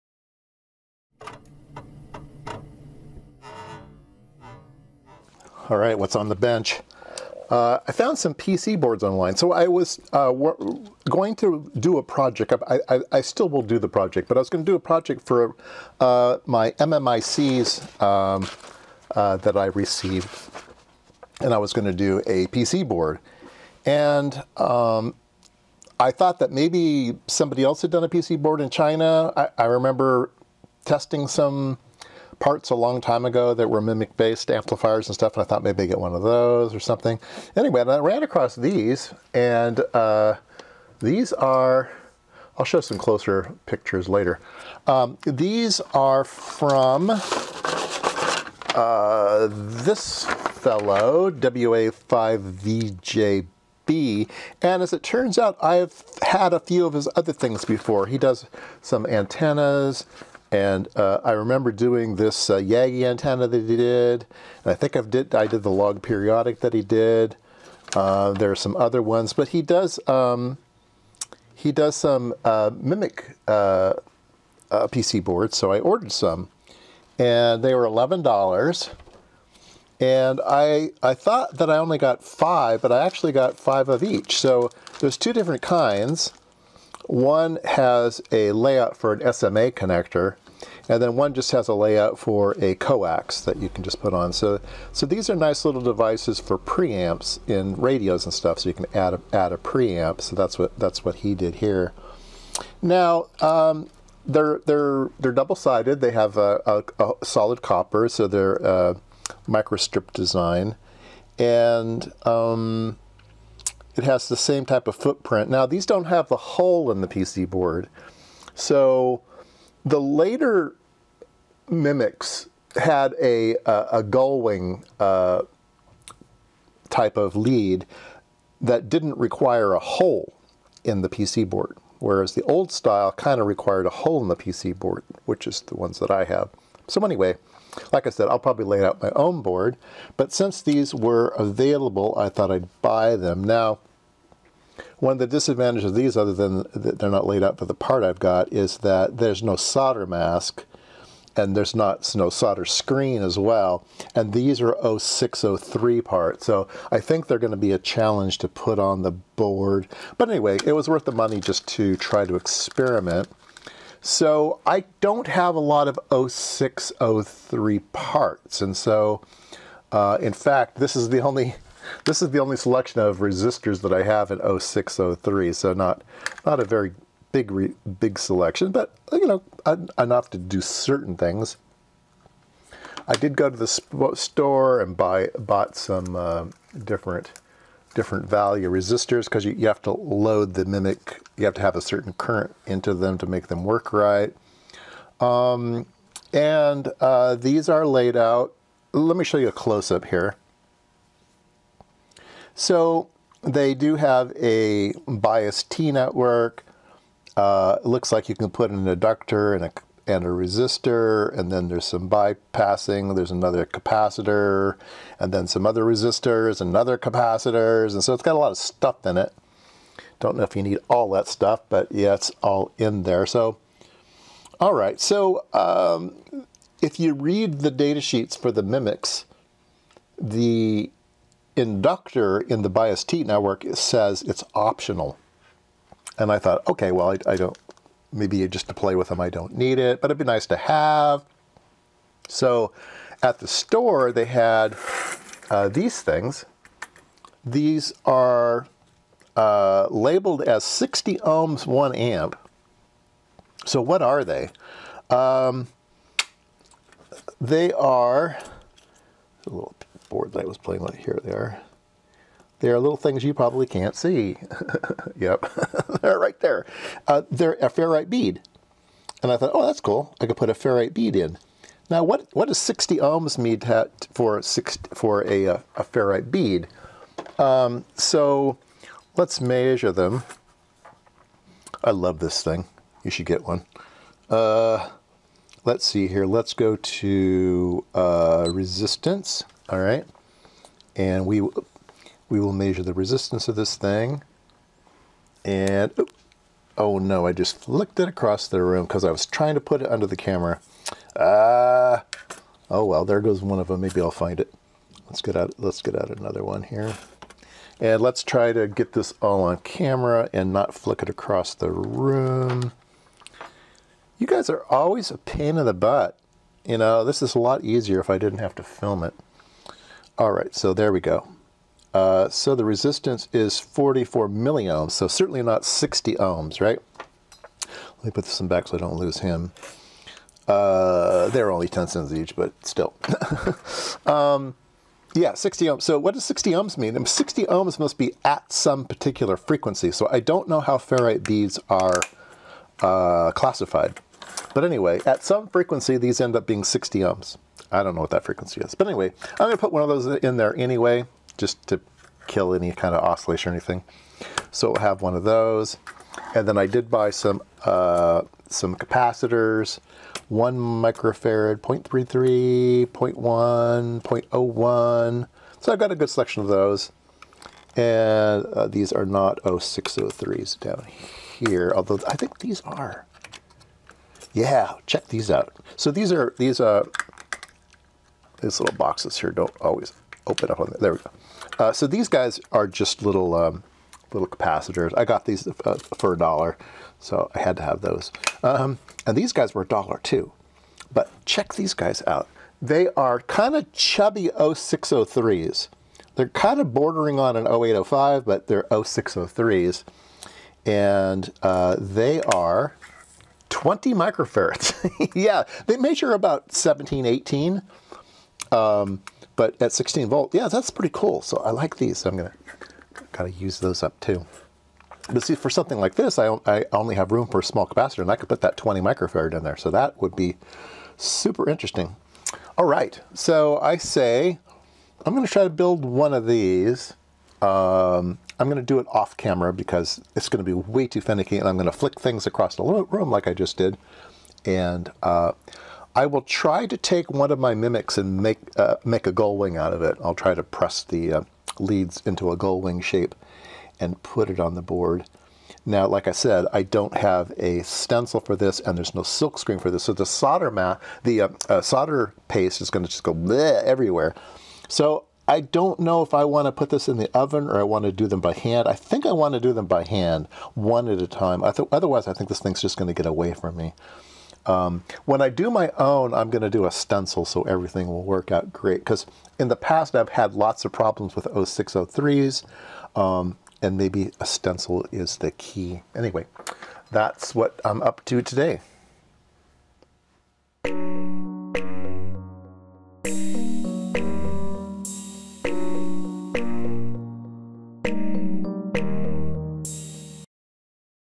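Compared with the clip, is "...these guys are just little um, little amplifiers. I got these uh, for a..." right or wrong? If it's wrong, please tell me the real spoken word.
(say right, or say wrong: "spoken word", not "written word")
wrong: "capacitors", not "amplifiers".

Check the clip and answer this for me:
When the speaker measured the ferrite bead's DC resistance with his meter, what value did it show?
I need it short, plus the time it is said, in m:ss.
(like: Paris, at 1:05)
44 milliohms, at 5:23.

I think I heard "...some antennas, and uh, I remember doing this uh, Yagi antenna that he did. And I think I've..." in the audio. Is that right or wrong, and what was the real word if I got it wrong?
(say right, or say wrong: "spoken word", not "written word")
right.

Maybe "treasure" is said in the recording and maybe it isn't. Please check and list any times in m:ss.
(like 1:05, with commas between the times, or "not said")
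not said.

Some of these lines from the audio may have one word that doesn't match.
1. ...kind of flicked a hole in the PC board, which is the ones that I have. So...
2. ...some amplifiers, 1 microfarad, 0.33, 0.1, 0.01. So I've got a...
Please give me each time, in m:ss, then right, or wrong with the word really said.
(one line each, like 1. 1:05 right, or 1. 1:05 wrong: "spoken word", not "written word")
1. 2:13 wrong: "required", not "flicked"
2. 5:58 wrong: "capacitors", not "amplifiers".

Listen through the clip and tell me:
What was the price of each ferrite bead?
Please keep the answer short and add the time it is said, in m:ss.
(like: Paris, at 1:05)
10 cents, at 5:31.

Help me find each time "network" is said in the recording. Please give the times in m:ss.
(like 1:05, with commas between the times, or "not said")
3:25, 3:53.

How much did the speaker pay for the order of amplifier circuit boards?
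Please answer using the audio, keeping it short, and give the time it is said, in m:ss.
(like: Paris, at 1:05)
$11, at 1:17.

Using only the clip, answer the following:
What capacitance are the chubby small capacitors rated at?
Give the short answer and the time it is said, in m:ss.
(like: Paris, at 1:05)
20 microfarads, at 6:43.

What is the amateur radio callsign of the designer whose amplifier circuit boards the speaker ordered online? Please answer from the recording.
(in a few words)
WA5VJB.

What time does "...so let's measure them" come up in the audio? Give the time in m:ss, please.
4:37.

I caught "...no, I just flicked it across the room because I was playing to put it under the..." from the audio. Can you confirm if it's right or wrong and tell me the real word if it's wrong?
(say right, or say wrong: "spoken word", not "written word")
wrong: "trying", not "playing".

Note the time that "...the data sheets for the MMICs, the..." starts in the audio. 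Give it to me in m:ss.
3:47.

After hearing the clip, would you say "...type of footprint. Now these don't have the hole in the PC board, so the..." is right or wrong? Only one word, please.
right.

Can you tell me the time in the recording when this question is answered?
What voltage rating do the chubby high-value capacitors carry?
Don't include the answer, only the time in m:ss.
6:49.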